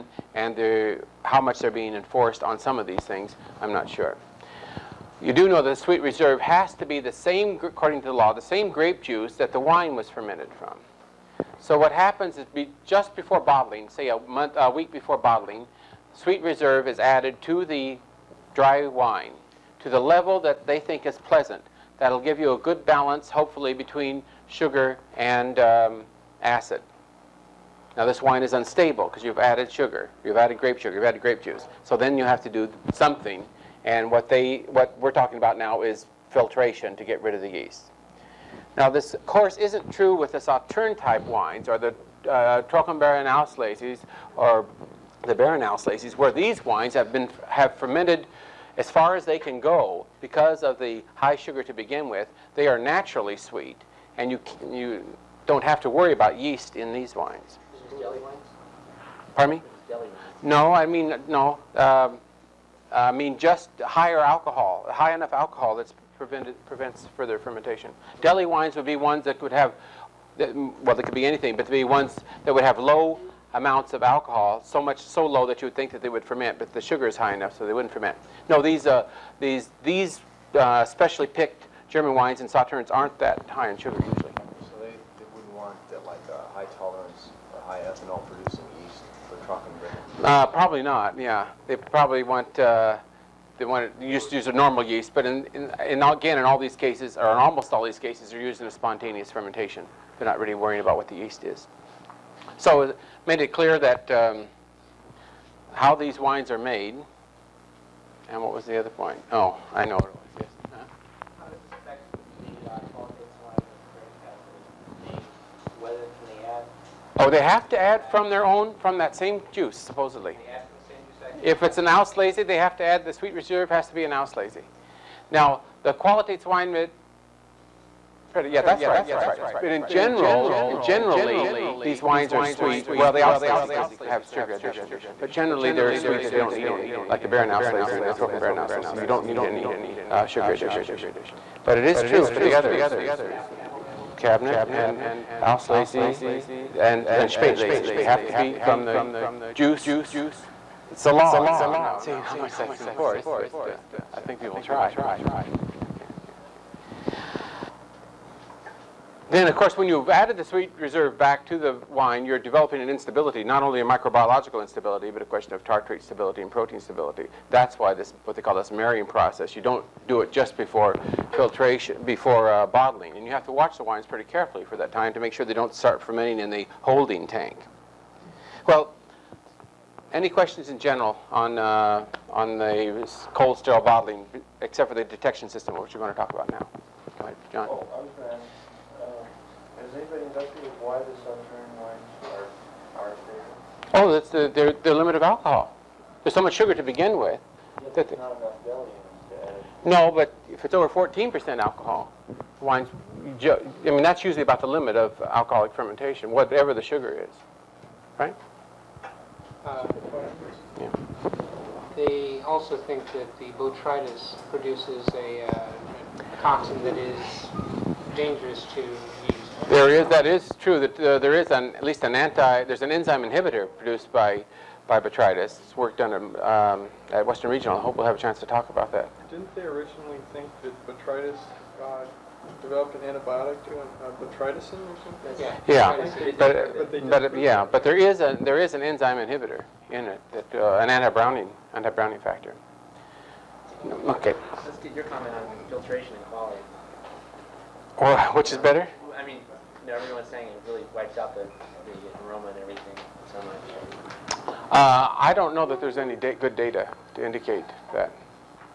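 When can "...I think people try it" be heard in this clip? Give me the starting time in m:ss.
2:34.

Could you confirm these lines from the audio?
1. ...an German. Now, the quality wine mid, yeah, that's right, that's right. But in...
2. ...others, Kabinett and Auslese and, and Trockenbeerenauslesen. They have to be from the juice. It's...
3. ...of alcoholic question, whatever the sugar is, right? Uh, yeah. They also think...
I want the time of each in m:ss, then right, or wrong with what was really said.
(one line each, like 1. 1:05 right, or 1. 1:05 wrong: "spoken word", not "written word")
1. 2:04 wrong: "Auslese", not "German"
2. 2:22 wrong: "Spätlese", not "Trockenbeerenauslesen"
3. 3:24 wrong: "fermentation", not "question".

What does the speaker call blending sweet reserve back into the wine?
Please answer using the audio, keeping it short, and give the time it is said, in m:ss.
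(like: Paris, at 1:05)
marrying process, at 2:48.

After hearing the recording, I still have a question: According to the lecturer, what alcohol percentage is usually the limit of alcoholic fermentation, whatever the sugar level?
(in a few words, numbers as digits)
14%.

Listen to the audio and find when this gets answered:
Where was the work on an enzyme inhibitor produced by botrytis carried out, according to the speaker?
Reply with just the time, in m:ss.
3:47.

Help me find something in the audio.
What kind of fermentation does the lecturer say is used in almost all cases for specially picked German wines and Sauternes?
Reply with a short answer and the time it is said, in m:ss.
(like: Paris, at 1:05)
spontaneous fermentation, at 1:38.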